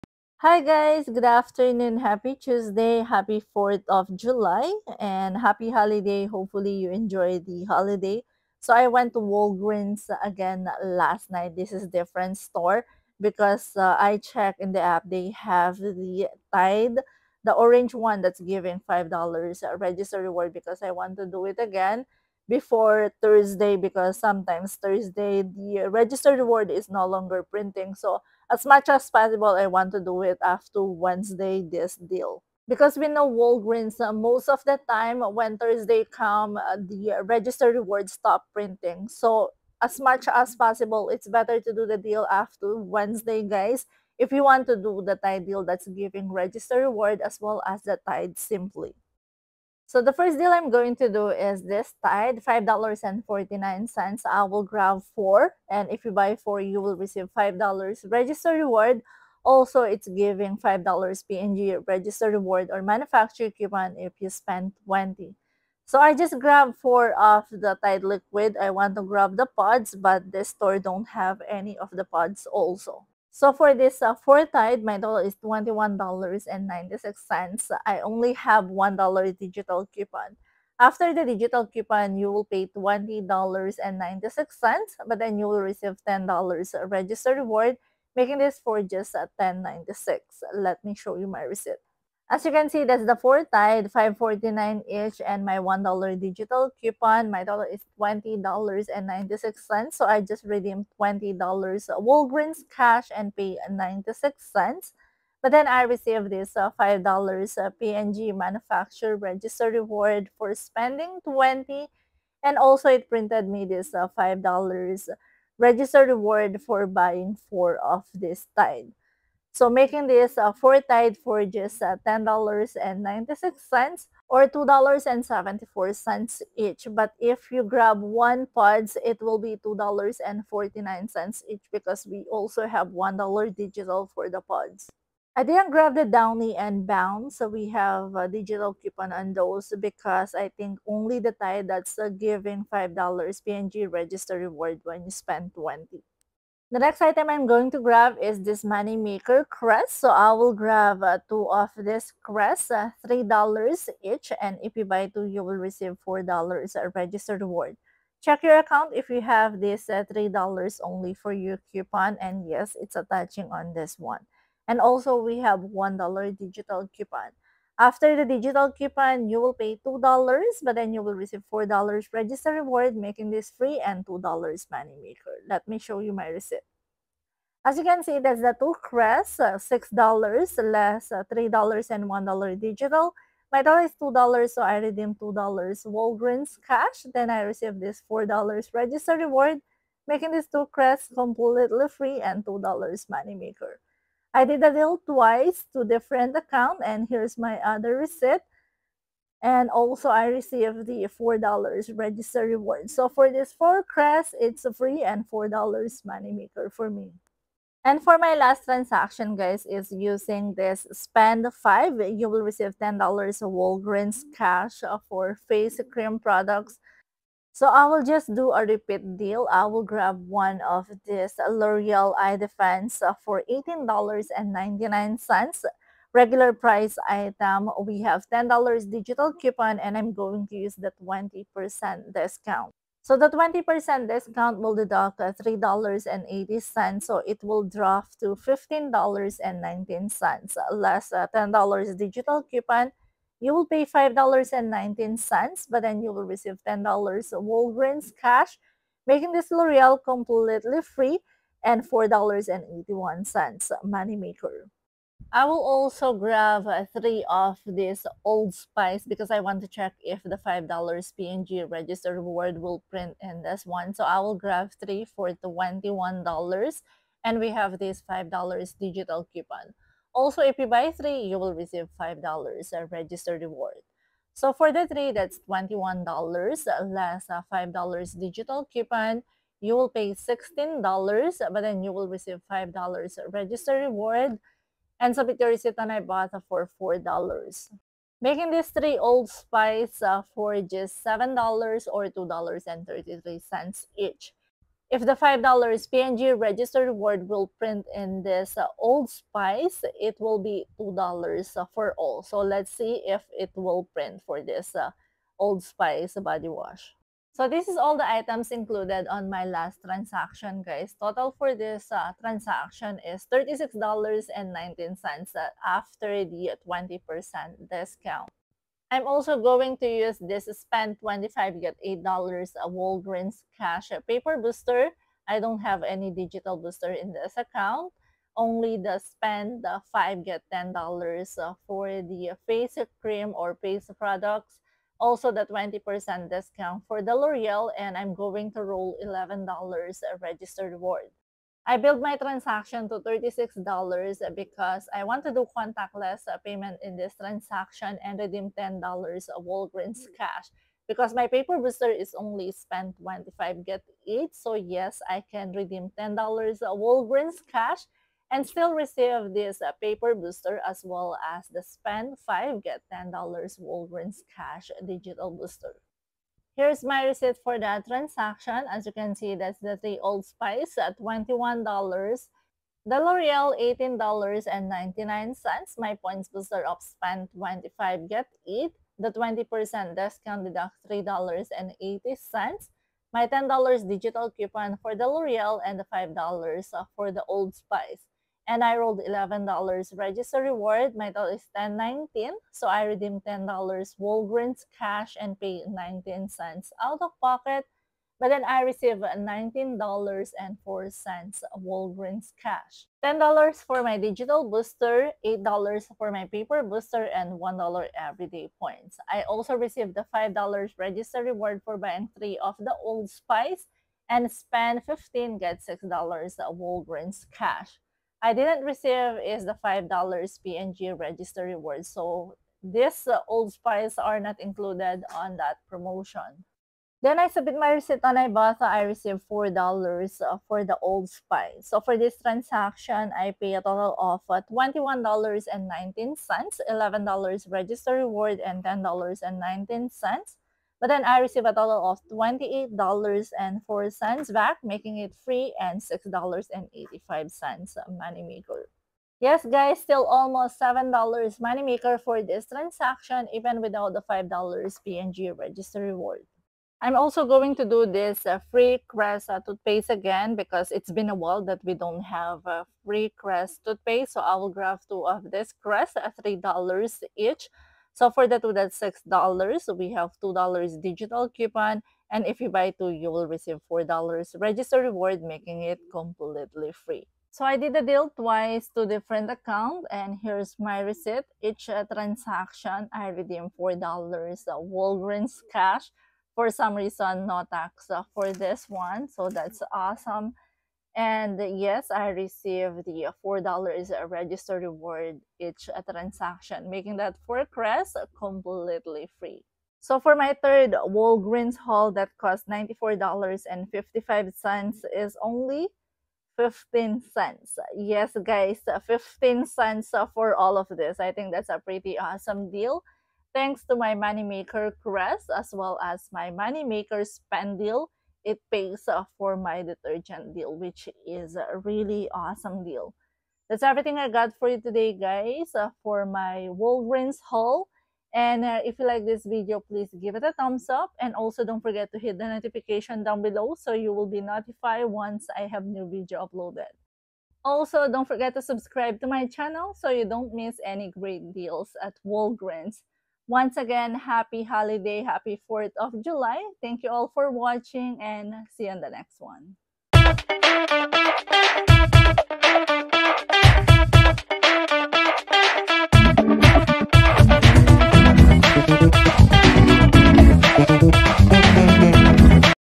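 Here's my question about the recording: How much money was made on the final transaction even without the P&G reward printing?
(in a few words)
$6.85.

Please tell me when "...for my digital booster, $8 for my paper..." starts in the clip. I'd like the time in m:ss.
6:43.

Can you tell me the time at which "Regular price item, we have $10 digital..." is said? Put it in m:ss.
3:46.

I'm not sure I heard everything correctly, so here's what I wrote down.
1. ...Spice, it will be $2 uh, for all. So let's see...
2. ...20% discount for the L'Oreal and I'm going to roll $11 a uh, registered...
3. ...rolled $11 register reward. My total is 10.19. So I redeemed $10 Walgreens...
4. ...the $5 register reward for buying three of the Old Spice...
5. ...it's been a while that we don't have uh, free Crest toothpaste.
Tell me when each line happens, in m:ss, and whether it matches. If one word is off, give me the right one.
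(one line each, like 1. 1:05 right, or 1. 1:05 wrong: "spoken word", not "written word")
1. 4:59 right
2. 5:35 right
3. 6:28 right
4. 6:49 right
5. 7:40 right.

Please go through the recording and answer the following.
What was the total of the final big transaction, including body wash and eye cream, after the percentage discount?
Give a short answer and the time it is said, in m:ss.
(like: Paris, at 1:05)
$36.19, at 5:13.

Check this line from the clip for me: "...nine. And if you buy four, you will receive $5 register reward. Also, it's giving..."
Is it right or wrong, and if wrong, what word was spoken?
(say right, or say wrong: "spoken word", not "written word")
wrong: "four", not "nine".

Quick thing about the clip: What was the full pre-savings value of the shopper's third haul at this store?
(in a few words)
$94.55.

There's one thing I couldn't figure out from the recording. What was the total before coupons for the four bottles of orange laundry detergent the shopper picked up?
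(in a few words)
$21.96.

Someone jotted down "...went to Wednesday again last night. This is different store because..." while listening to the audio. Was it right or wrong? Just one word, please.
wrong.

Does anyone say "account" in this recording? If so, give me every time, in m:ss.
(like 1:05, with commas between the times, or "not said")
2:38, 3:16, 5:27, 7:59.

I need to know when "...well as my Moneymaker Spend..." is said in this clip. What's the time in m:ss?
8:35.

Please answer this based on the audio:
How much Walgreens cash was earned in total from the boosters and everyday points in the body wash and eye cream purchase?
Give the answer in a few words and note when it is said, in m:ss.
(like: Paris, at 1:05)
$19.04, at 6:39.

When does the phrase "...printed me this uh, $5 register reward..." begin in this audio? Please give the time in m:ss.
1:53.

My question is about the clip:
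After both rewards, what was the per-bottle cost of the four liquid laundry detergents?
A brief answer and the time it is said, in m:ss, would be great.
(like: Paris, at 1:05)
$2.74, at 2:04.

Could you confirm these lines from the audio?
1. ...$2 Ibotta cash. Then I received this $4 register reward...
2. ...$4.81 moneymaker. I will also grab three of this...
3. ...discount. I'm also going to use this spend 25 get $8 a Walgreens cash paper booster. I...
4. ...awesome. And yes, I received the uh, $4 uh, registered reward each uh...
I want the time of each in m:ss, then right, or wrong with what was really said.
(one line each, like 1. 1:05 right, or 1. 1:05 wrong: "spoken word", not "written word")
1. 3:05 wrong: "Walgreens", not "Ibotta"
2. 4:11 right
3. 5:17 right
4. 8:09 right.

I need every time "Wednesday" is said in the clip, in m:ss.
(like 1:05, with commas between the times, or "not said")
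0:30, 0:42.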